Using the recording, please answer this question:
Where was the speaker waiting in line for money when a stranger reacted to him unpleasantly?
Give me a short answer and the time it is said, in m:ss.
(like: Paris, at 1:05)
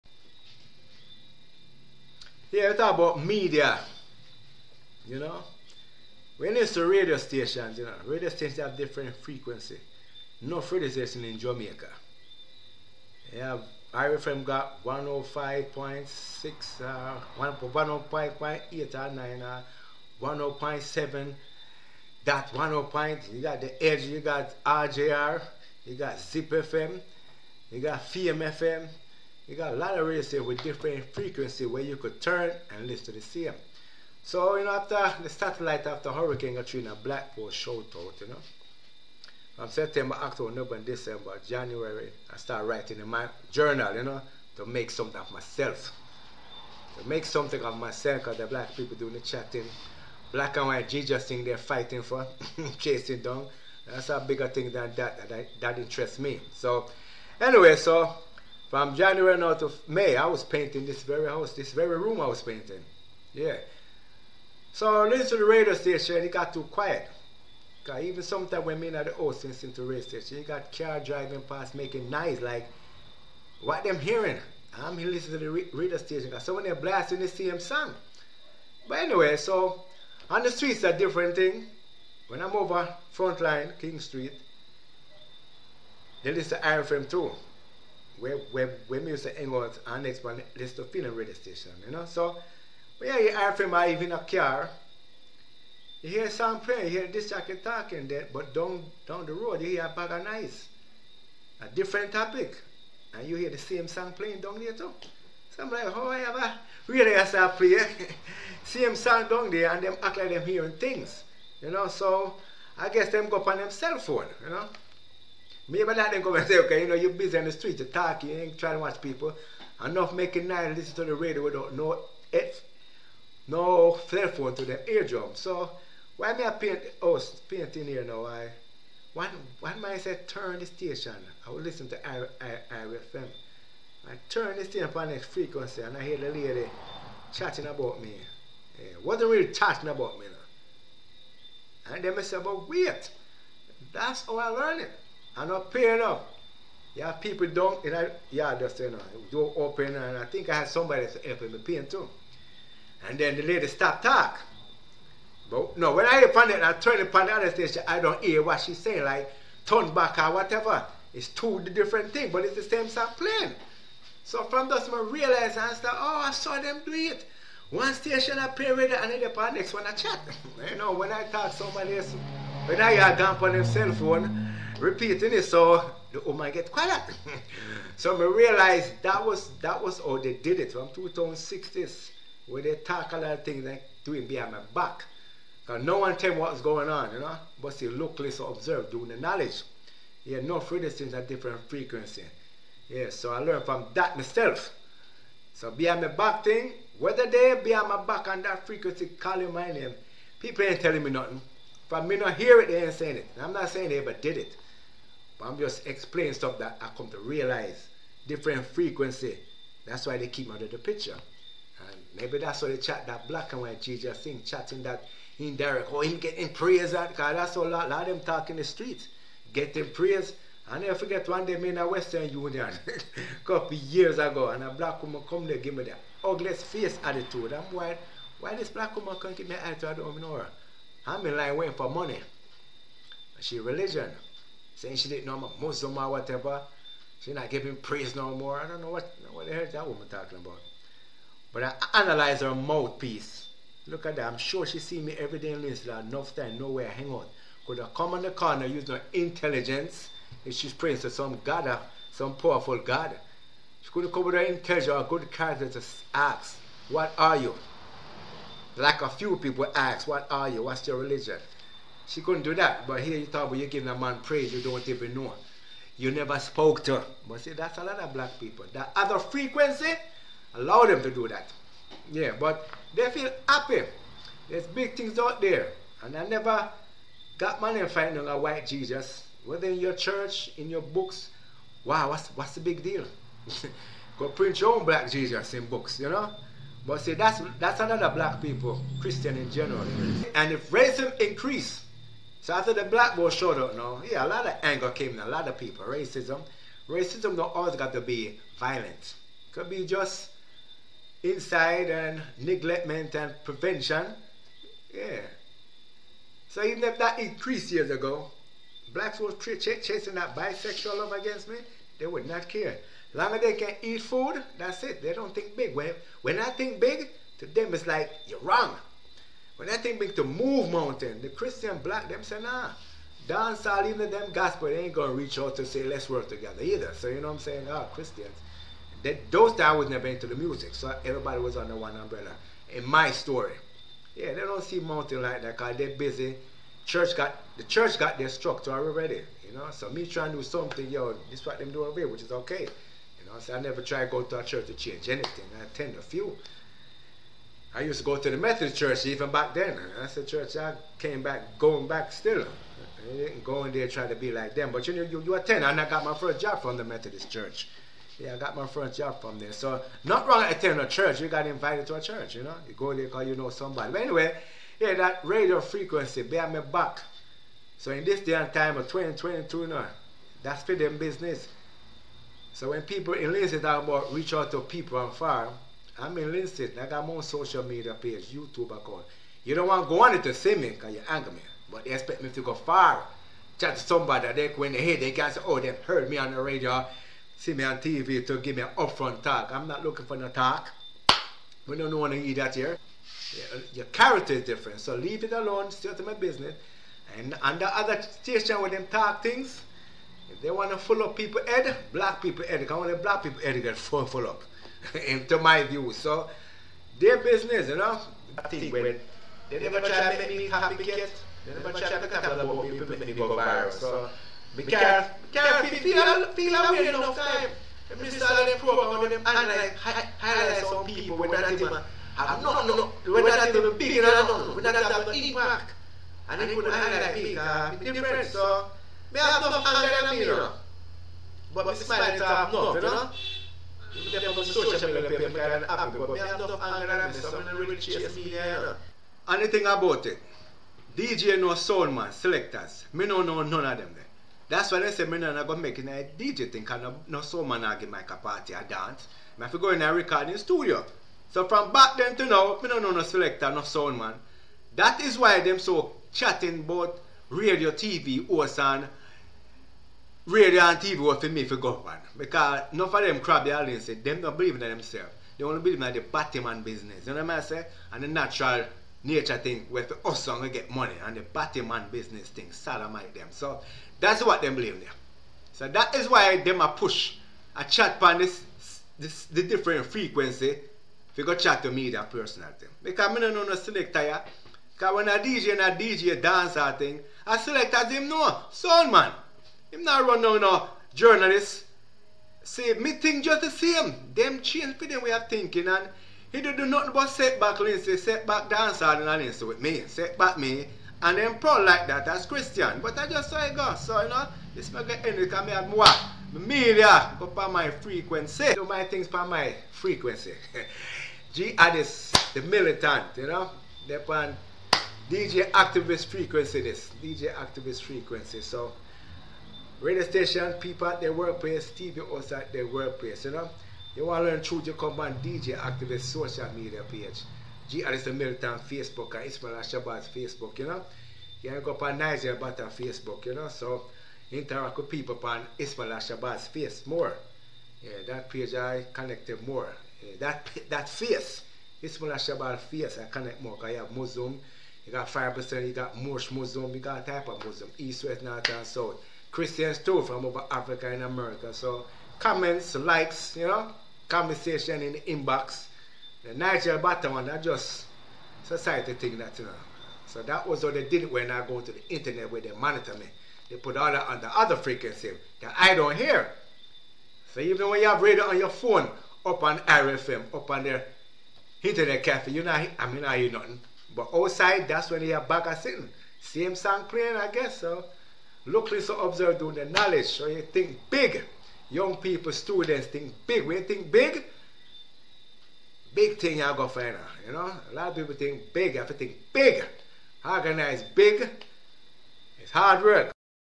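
Western Union, at 3:41.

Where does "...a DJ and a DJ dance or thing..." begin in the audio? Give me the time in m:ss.
8:05.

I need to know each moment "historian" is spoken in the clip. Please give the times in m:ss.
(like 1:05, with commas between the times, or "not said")
not said.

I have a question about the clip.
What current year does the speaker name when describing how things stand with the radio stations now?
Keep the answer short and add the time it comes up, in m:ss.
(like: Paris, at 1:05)
2022, at 6:08.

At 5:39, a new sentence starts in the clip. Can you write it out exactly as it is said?
So me trying to do something, yo, this what them do over here, which is okay.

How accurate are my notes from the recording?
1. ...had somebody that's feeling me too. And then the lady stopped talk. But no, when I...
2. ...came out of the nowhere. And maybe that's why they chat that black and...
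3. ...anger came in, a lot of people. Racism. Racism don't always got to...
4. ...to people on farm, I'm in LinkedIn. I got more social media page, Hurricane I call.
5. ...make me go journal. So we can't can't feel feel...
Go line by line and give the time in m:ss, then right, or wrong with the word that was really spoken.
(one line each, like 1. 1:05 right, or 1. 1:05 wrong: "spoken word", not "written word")
1. 2:30 wrong: "helping", not "feeling"
2. 3:30 wrong: "picture", not "nowhere"
3. 4:54 right
4. 6:14 wrong: "YouTube", not "Hurricane"
5. 6:52 wrong: "viral", not "journal".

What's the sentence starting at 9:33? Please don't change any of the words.
But outside that's when you have back sitting.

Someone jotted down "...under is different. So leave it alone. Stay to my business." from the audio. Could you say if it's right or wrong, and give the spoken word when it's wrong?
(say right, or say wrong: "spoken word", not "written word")
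wrong: "character", not "under".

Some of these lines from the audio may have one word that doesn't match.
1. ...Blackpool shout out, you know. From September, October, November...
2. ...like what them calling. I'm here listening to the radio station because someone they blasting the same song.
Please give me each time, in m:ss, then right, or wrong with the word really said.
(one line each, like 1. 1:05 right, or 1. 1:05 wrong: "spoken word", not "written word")
1. 0:37 right
2. 1:12 wrong: "hearing", not "calling".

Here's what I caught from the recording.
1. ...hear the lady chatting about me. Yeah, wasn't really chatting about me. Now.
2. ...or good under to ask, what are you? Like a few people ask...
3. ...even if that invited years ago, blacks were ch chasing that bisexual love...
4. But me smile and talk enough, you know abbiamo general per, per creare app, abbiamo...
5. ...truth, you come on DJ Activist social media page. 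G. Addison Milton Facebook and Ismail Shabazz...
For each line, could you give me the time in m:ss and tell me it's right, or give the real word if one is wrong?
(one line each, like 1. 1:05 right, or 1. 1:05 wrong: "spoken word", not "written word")
1. 2:16 right
2. 4:14 wrong: "character", not "under"
3. 5:06 wrong: "increased", not "invited"
4. 7:11 wrong: "social", not "general"
5. 8:44 right.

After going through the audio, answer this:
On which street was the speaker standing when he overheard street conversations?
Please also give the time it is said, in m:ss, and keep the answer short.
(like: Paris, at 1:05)
King Street, at 1:23.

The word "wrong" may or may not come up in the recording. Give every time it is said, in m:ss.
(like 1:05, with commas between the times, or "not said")
5:18, 6:00.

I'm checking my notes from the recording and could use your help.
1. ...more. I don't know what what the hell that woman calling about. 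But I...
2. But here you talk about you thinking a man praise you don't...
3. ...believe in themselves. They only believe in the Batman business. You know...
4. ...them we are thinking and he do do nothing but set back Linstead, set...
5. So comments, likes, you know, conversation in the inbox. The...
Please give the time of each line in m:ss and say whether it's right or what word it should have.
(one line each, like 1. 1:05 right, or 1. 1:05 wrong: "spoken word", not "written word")
1. 3:58 wrong: "talking", not "calling"
2. 4:22 wrong: "giving", not "thinking"
3. 7:44 right
4. 8:14 right
5. 9:11 right.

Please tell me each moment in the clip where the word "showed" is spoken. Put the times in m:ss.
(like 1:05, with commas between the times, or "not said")
4:53.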